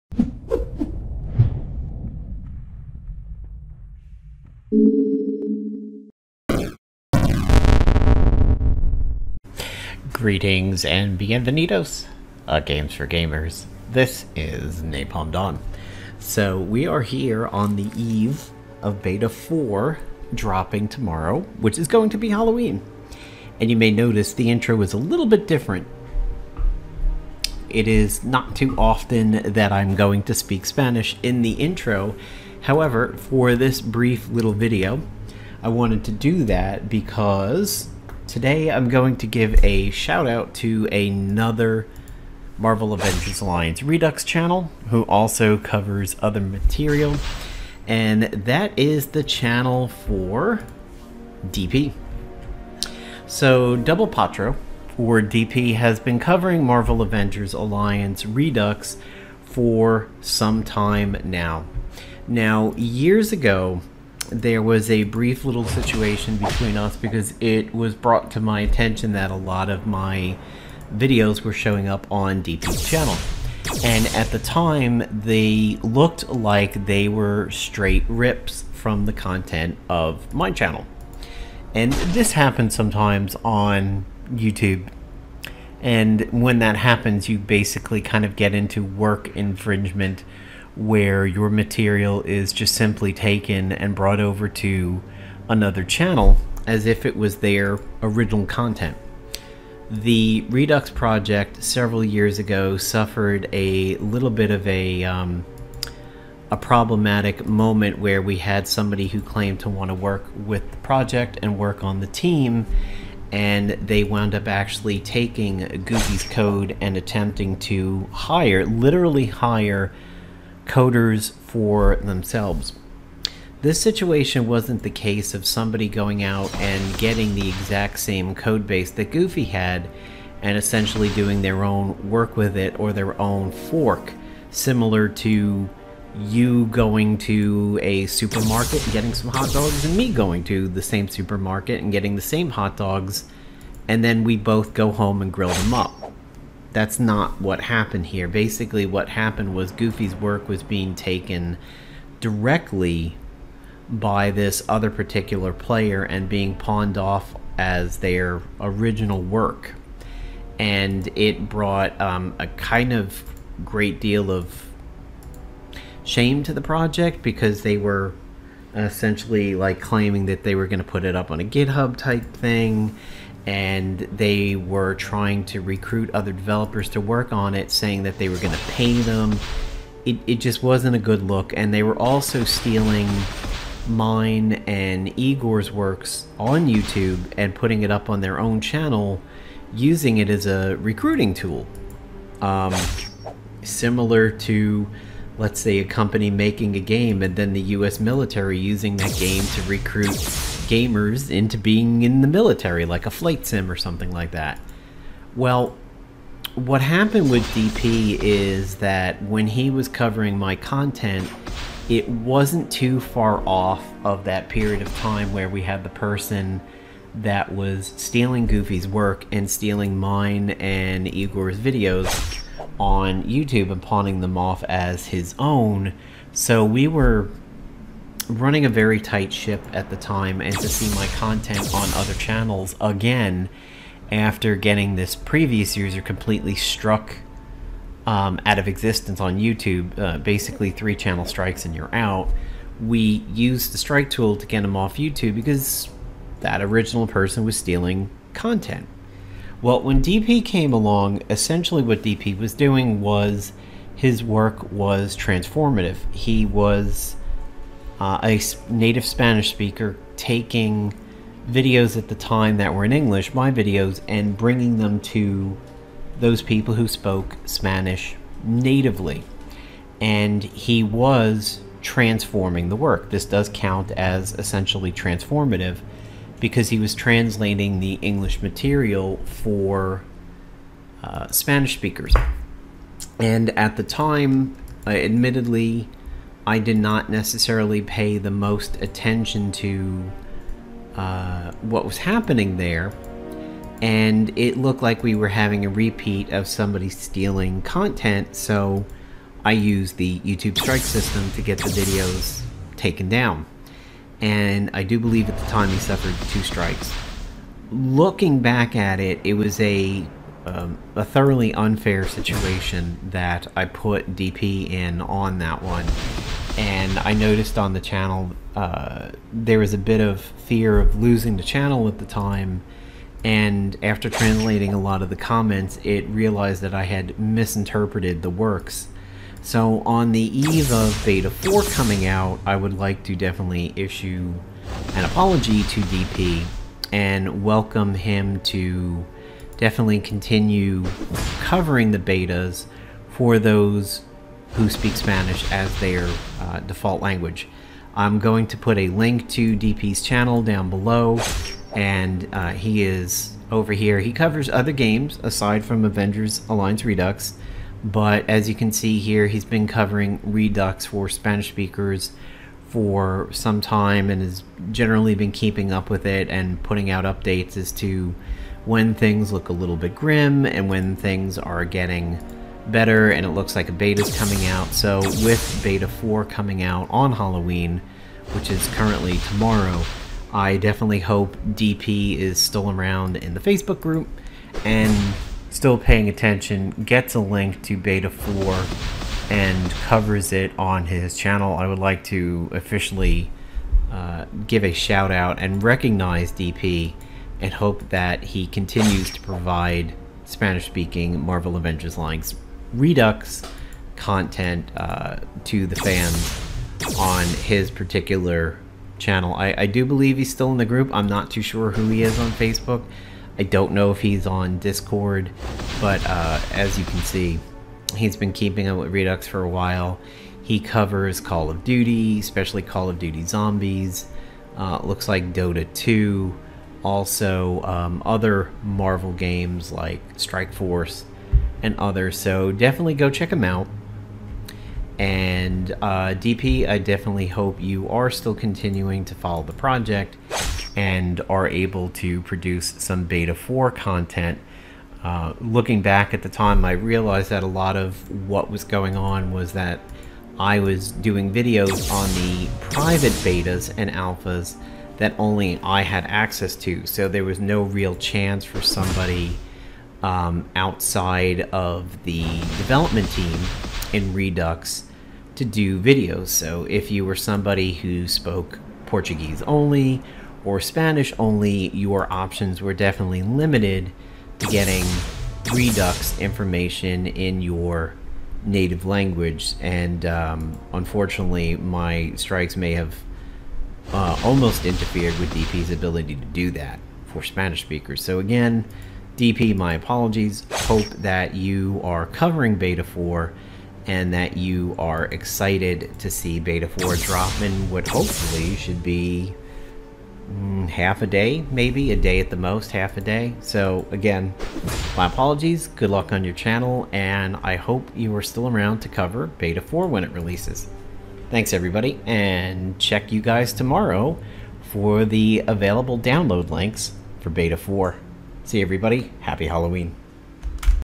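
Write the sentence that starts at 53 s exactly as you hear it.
So Double Patro or DP has been covering Marvel Avengers Alliance Redux for some time now.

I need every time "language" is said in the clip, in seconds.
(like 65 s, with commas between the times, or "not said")
347 s, 478 s.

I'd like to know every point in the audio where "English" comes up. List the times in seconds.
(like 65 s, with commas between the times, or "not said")
262 s, 278 s.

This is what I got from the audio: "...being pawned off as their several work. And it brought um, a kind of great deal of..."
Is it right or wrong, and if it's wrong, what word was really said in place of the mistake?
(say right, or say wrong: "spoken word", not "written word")
wrong: "original", not "several".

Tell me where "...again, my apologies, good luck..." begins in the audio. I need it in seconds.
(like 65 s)
503 s.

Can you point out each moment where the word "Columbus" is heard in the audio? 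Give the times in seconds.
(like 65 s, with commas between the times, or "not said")
not said.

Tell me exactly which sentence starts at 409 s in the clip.
I, I do believe he's still in the group.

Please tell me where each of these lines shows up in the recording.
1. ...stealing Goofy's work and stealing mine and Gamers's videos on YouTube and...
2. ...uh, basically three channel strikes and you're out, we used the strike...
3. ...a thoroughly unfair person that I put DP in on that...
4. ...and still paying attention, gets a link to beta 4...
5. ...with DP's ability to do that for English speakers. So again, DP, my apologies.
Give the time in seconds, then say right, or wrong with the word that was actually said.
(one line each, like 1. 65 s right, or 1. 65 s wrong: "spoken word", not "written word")
1. 217 s wrong: "Igor", not "Gamers"
2. 239 s right
3. 310 s wrong: "situation", not "person"
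4. 384 s right
5. 485 s wrong: "Spanish", not "English".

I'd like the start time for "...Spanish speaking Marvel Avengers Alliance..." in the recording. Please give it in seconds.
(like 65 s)
400 s.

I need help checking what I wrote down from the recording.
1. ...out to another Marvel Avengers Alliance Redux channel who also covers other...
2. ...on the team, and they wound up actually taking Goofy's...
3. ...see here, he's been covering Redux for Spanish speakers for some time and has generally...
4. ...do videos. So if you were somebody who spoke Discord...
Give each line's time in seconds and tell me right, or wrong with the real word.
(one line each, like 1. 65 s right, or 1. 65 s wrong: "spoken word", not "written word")
1. 40 s right
2. 111 s right
3. 358 s right
4. 465 s wrong: "Portuguese", not "Discord".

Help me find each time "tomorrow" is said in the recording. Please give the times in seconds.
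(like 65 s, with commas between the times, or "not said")
20 s, 379 s, 513 s.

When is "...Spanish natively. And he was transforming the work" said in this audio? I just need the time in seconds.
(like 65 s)
267 s.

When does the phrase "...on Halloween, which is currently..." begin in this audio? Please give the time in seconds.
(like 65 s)
376 s.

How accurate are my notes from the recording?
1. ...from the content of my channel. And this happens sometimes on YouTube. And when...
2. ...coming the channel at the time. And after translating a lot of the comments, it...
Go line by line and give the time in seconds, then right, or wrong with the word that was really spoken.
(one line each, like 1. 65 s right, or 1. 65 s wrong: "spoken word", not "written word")
1. 78 s right
2. 321 s wrong: "losing", not "coming".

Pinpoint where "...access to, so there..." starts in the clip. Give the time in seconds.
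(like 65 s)
456 s.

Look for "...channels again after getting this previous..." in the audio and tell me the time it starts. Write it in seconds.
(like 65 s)
232 s.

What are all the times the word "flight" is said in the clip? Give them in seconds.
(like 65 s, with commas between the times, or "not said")
203 s.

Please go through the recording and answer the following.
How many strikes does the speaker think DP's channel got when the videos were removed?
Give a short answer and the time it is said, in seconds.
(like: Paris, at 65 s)
2, at 306 s.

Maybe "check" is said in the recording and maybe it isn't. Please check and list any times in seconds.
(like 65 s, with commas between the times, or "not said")
433 s, 512 s.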